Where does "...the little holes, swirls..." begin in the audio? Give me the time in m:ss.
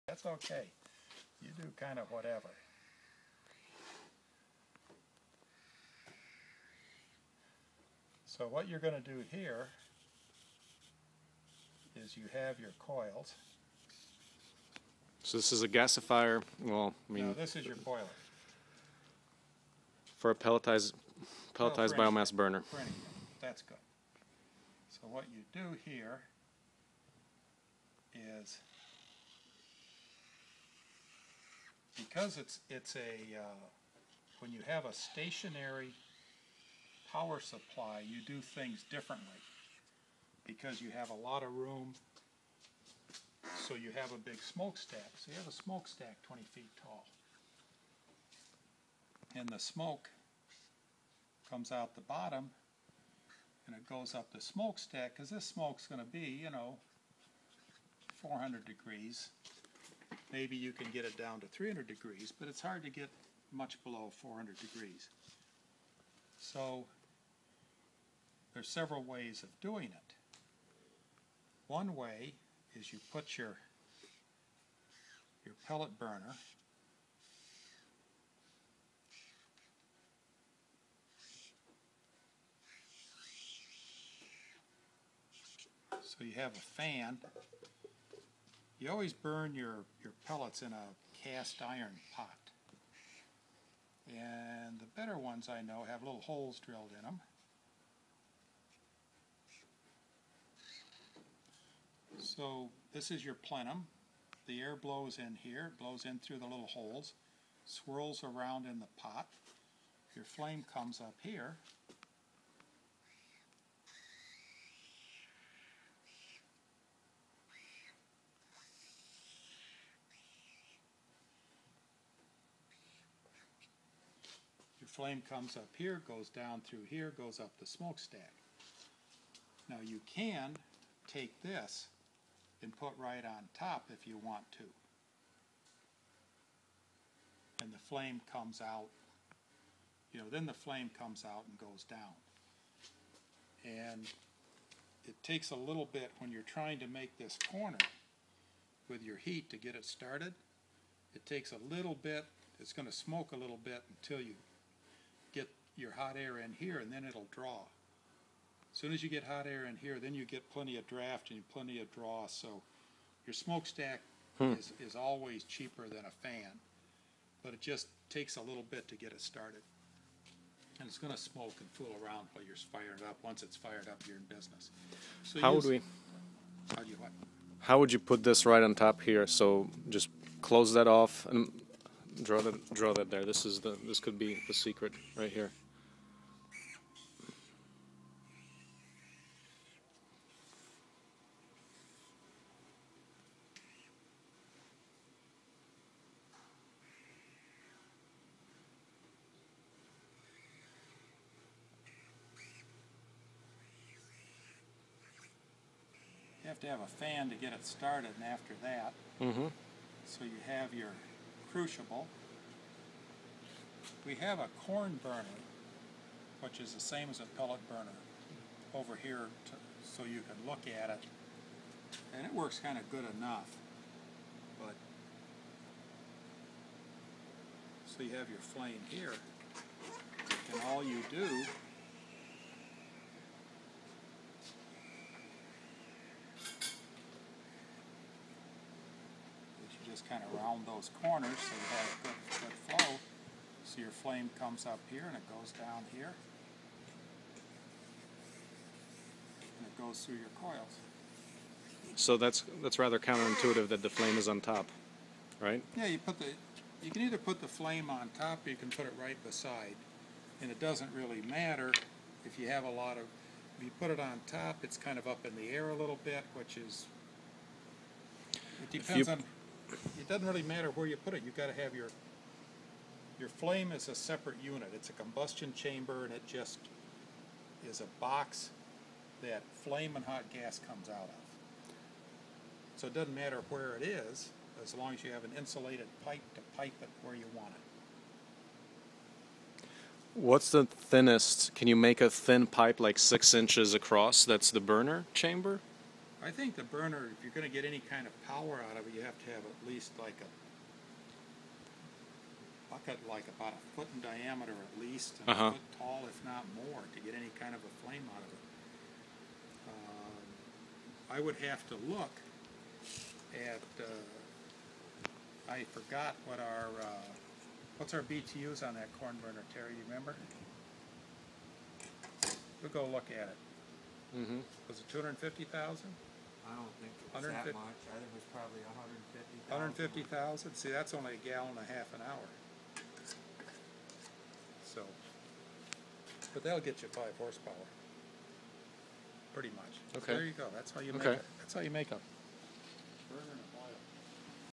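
1:46.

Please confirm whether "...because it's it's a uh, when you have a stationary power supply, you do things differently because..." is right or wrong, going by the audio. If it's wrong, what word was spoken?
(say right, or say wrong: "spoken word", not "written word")
right.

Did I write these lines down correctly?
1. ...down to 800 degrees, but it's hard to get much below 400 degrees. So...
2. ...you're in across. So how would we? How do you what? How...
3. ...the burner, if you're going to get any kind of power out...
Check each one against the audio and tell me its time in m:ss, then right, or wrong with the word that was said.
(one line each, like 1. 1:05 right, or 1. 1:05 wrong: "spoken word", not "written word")
1. 1:01 wrong: "300", not "800"
2. 2:54 wrong: "business", not "across"
3. 4:56 right.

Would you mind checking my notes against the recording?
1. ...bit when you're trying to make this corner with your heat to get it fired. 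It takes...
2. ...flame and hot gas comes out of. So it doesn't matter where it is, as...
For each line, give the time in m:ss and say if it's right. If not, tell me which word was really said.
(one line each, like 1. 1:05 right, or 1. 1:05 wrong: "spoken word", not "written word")
1. 2:25 wrong: "started", not "fired"
2. 4:39 right.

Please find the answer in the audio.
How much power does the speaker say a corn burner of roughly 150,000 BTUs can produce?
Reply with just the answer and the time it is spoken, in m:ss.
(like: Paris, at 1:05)
5 horsepower, at 5:36.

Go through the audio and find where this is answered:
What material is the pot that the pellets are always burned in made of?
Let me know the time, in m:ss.
1:31.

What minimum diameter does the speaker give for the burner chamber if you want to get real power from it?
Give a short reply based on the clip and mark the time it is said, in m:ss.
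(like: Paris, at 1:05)
About a foot, at 5:03.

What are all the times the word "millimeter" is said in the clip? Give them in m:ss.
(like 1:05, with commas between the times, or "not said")
not said.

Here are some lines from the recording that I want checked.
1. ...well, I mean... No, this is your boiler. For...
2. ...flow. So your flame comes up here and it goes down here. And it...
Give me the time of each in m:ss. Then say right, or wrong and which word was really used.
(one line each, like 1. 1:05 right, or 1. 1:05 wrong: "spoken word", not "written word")
1. 0:16 right
2. 4:02 right.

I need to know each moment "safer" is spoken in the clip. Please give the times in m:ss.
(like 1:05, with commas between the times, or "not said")
not said.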